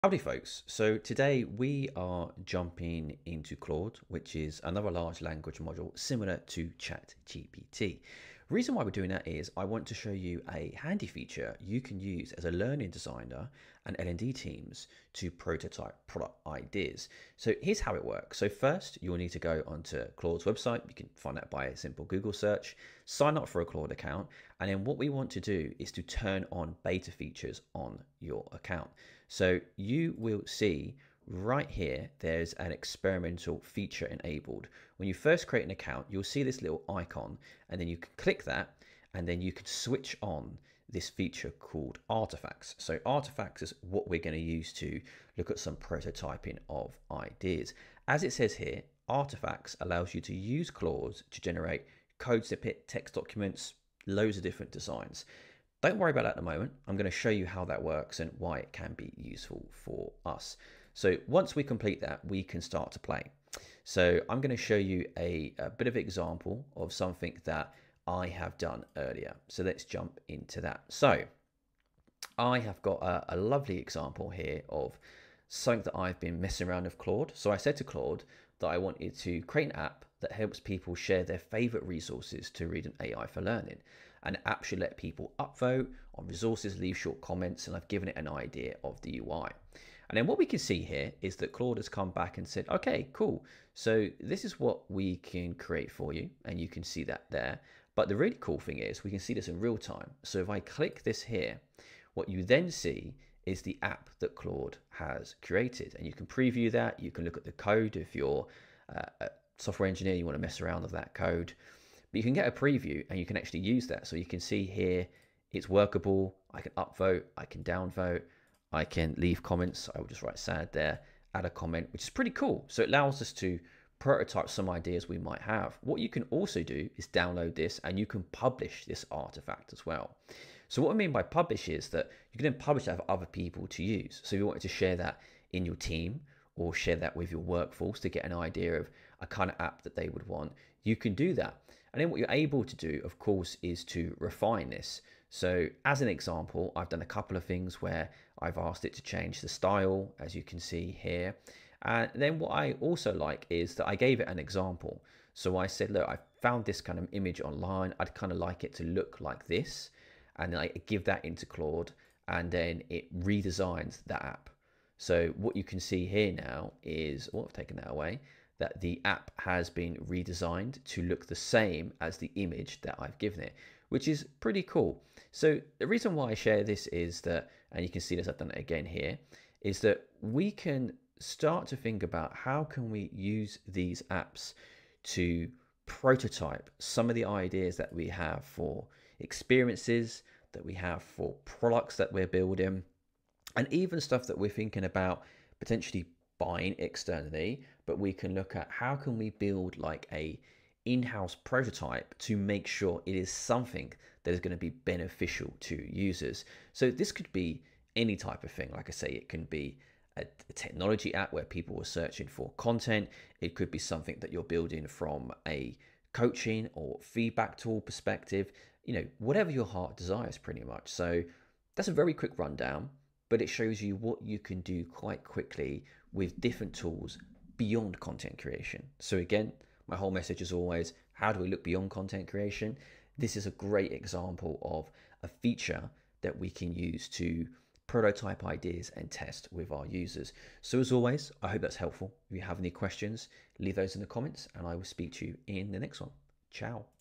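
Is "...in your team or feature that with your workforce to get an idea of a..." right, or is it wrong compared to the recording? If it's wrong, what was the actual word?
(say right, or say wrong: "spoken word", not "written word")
wrong: "share", not "feature".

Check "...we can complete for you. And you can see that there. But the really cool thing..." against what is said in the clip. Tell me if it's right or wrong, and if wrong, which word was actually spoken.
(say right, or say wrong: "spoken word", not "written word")
wrong: "create", not "complete".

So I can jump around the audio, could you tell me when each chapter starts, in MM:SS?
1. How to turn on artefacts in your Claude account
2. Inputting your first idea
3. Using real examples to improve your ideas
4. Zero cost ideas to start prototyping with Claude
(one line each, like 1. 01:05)
1. 00:25
2. 00:47
3. 01:34
4. 02:15.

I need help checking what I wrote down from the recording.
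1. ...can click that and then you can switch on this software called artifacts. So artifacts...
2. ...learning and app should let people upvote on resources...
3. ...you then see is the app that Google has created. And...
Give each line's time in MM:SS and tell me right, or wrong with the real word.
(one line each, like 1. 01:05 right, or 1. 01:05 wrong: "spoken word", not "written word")
1. 00:37 wrong: "feature", not "software"
2. 01:23 right
3. 01:42 wrong: "Claude", not "Google".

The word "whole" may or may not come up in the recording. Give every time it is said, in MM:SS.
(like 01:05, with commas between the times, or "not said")
03:49.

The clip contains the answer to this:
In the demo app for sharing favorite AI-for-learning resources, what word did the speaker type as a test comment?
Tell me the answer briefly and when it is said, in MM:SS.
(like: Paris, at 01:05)
sad, at 02:00.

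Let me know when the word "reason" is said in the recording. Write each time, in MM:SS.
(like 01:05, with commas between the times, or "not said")
00:08, 02:55.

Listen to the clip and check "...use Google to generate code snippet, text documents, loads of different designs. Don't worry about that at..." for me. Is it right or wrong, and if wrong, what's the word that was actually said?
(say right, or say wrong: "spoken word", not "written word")
wrong: "Claude", not "Google".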